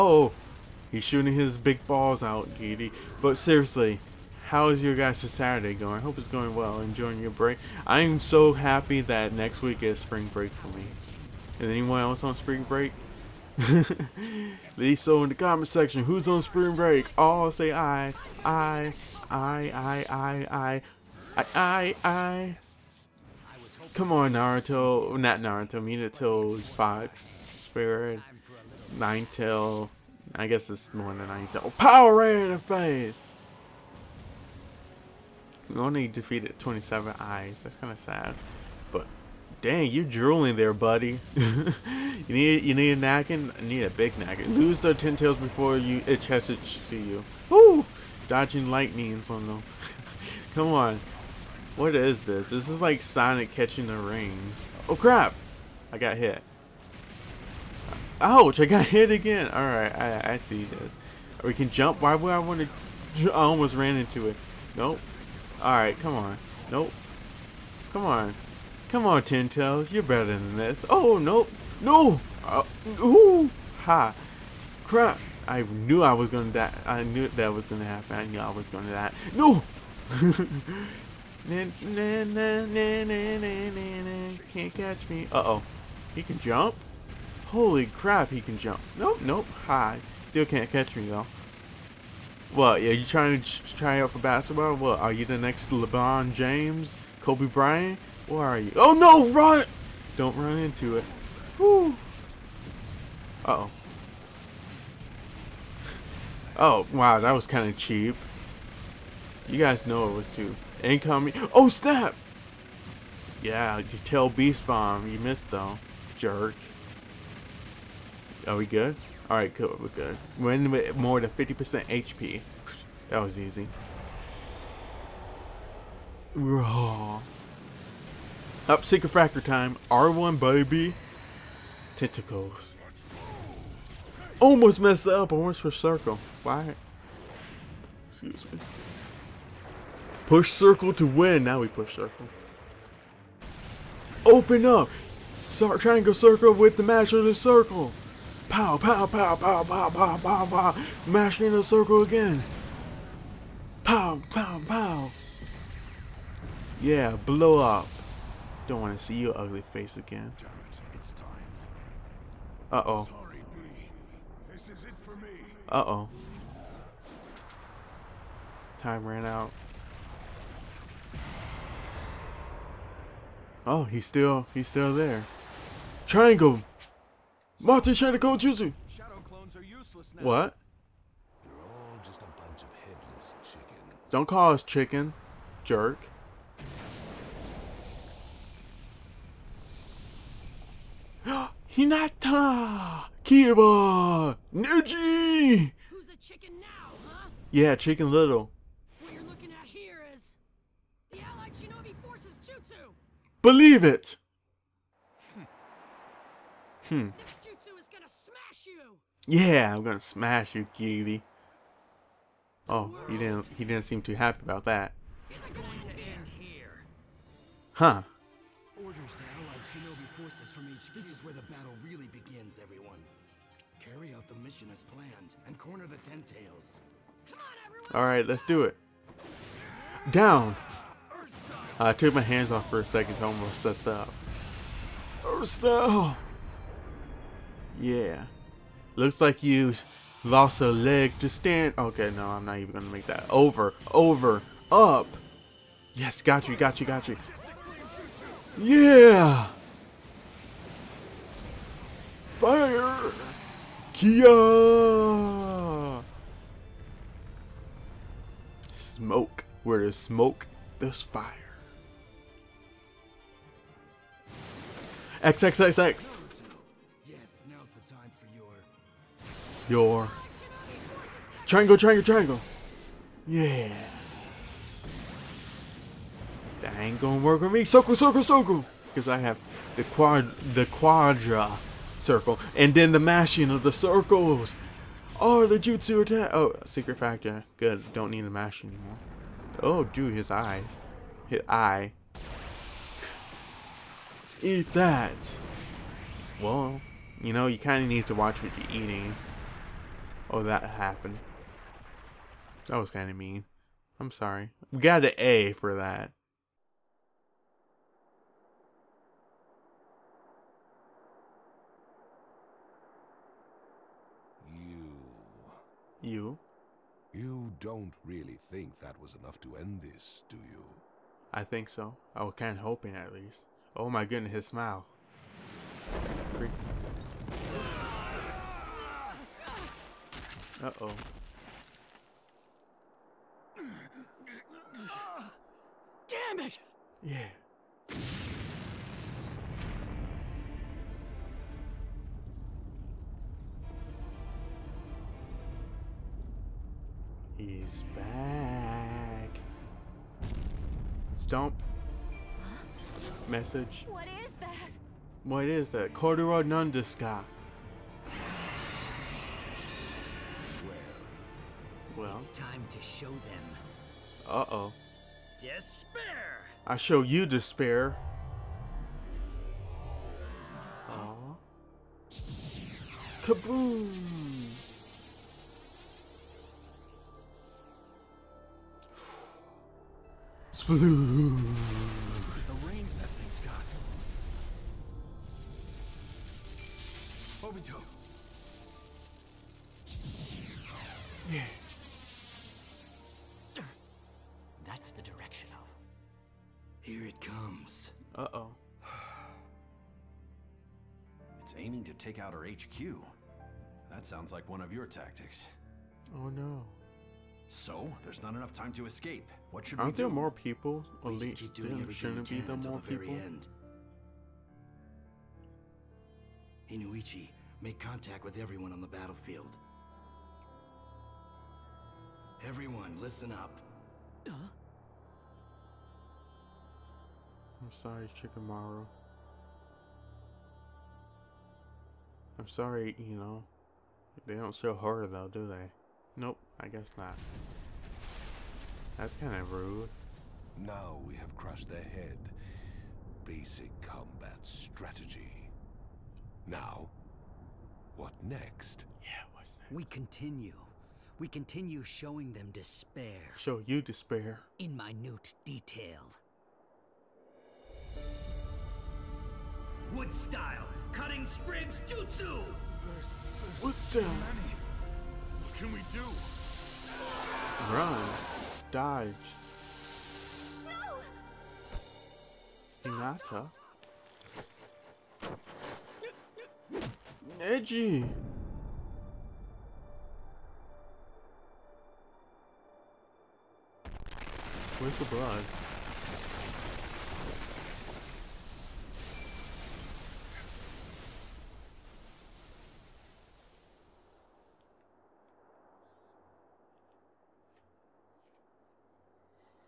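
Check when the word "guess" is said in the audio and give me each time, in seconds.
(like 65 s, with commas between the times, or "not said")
30 s, 436 s.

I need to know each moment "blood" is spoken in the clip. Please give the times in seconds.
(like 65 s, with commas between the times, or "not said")
485 s.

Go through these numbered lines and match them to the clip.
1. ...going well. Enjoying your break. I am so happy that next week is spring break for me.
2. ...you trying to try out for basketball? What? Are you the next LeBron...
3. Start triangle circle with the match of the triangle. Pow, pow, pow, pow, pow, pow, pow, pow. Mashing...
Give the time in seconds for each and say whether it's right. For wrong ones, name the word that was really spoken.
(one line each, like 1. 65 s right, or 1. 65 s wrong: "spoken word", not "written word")
1. 6 s right
2. 92 s right
3. 145 s wrong: "circle", not "triangle".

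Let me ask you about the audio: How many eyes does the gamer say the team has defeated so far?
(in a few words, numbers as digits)
27.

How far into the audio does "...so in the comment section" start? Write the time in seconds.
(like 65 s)
14 s.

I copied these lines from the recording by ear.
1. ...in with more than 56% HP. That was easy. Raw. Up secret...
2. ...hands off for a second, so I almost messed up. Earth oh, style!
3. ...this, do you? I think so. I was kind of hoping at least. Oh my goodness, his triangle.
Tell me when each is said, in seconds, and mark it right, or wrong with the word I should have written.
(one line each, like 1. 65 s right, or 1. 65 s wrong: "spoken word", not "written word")
1. 120 s wrong: "50", not "56"
2. 232 s right
3. 319 s wrong: "smile", not "triangle".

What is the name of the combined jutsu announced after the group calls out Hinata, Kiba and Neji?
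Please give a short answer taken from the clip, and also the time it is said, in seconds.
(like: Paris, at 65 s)
Allied Shinobi Forces Jutsu, at 201 s.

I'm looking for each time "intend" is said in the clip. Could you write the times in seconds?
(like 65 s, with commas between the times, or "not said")
not said.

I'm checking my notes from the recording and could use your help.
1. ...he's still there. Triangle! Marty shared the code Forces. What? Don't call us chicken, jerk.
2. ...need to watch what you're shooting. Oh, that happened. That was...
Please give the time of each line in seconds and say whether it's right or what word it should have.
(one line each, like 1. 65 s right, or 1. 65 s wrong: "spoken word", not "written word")
1. 174 s wrong: "Jutsu", not "Forces"
2. 297 s wrong: "eating", not "shooting".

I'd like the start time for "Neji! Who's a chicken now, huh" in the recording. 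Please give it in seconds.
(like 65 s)
194 s.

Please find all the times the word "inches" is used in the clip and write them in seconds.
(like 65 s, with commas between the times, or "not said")
not said.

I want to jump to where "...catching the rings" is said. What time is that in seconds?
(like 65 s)
53 s.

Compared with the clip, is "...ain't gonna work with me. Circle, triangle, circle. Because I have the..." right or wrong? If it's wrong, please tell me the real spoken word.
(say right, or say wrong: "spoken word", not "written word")
wrong: "circle", not "triangle".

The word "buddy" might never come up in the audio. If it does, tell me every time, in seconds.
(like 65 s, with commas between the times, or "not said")
40 s.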